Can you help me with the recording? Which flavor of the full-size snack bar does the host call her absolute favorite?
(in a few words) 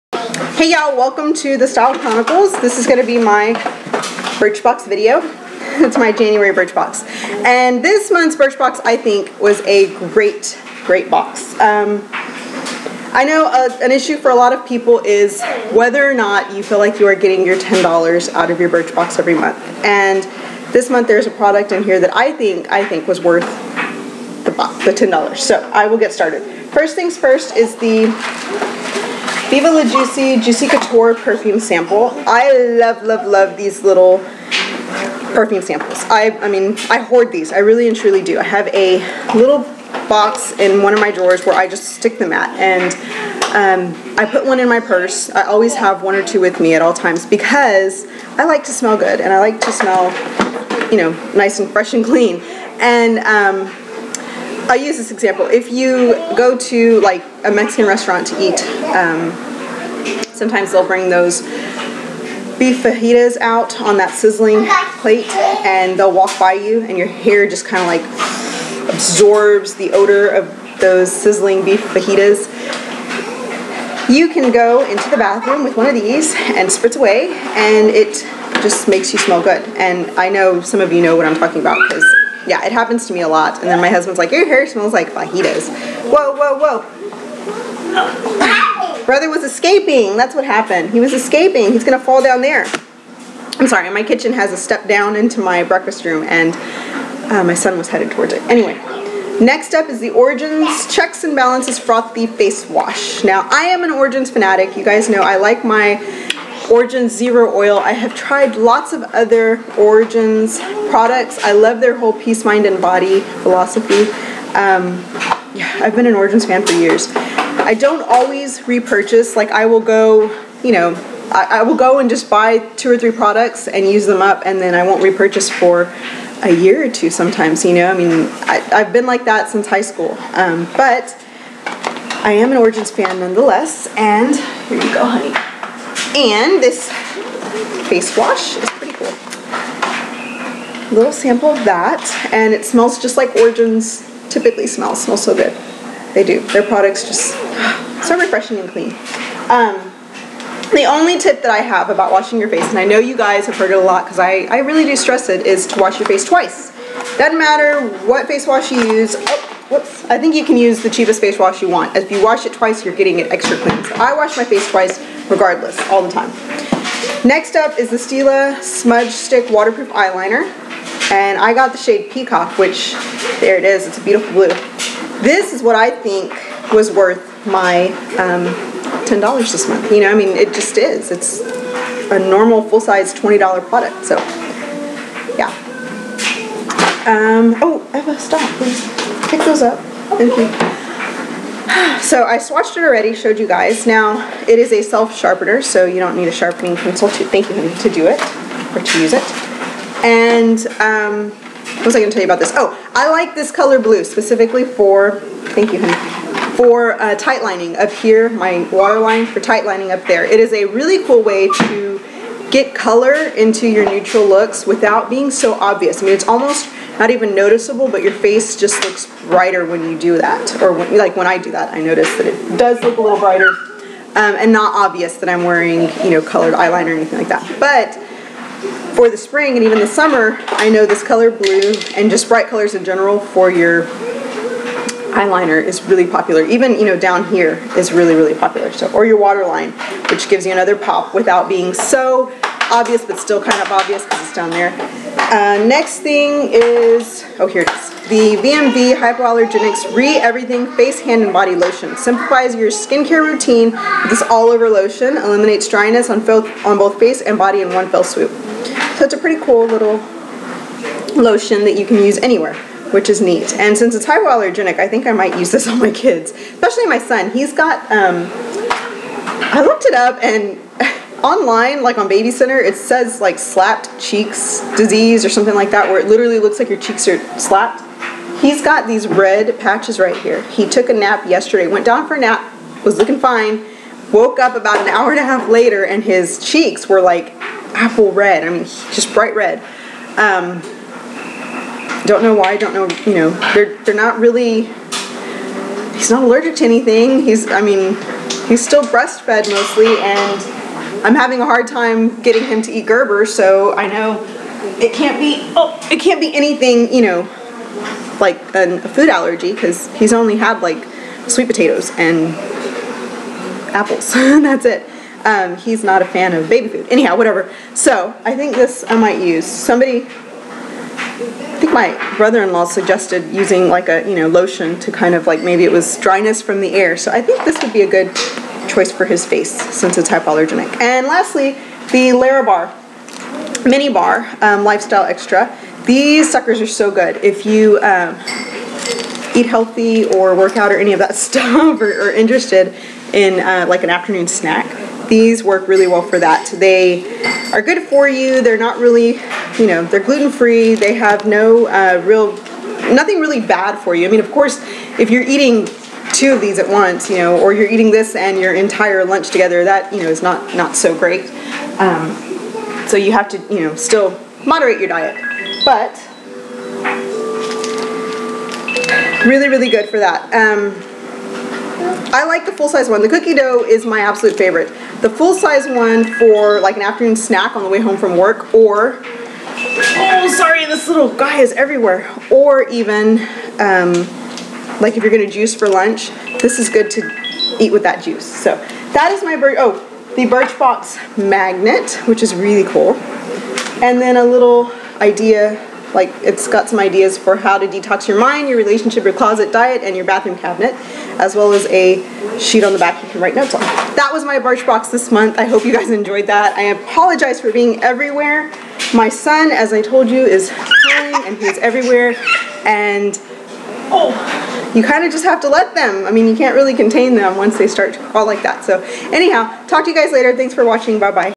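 Cookie dough.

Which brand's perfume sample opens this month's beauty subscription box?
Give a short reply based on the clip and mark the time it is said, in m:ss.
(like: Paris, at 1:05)
Viva La Juicy, at 0:29.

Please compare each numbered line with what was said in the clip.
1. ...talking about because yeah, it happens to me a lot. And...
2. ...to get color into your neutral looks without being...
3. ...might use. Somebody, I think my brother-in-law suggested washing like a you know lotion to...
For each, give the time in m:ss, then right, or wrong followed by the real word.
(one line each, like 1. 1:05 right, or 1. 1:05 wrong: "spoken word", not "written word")
1. 1:21 right
2. 3:31 right
3. 5:18 wrong: "using", not "washing".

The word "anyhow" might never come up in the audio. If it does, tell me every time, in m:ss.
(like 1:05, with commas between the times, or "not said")
5:16, 6:59.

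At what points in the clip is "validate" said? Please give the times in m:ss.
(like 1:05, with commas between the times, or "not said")
not said.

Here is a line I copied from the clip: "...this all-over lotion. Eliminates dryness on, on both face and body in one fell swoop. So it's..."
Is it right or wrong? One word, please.
right.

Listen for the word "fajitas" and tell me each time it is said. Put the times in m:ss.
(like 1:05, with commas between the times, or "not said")
1:02, 1:11, 1:25.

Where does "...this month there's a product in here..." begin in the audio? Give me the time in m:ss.
0:20.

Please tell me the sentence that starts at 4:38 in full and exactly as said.
He's got these red patches right here.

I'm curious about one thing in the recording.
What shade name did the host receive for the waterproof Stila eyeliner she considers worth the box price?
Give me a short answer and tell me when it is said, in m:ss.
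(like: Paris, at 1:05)
Peacock, at 2:52.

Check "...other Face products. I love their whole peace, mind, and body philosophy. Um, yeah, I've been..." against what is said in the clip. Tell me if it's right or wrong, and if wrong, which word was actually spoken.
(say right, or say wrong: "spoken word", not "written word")
wrong: "Origins", not "Face".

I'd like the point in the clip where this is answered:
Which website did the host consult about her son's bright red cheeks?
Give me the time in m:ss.
4:32.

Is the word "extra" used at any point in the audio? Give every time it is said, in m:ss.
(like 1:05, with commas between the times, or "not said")
2:43, 5:35.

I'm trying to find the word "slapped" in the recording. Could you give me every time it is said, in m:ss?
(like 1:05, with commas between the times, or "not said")
4:33, 4:37.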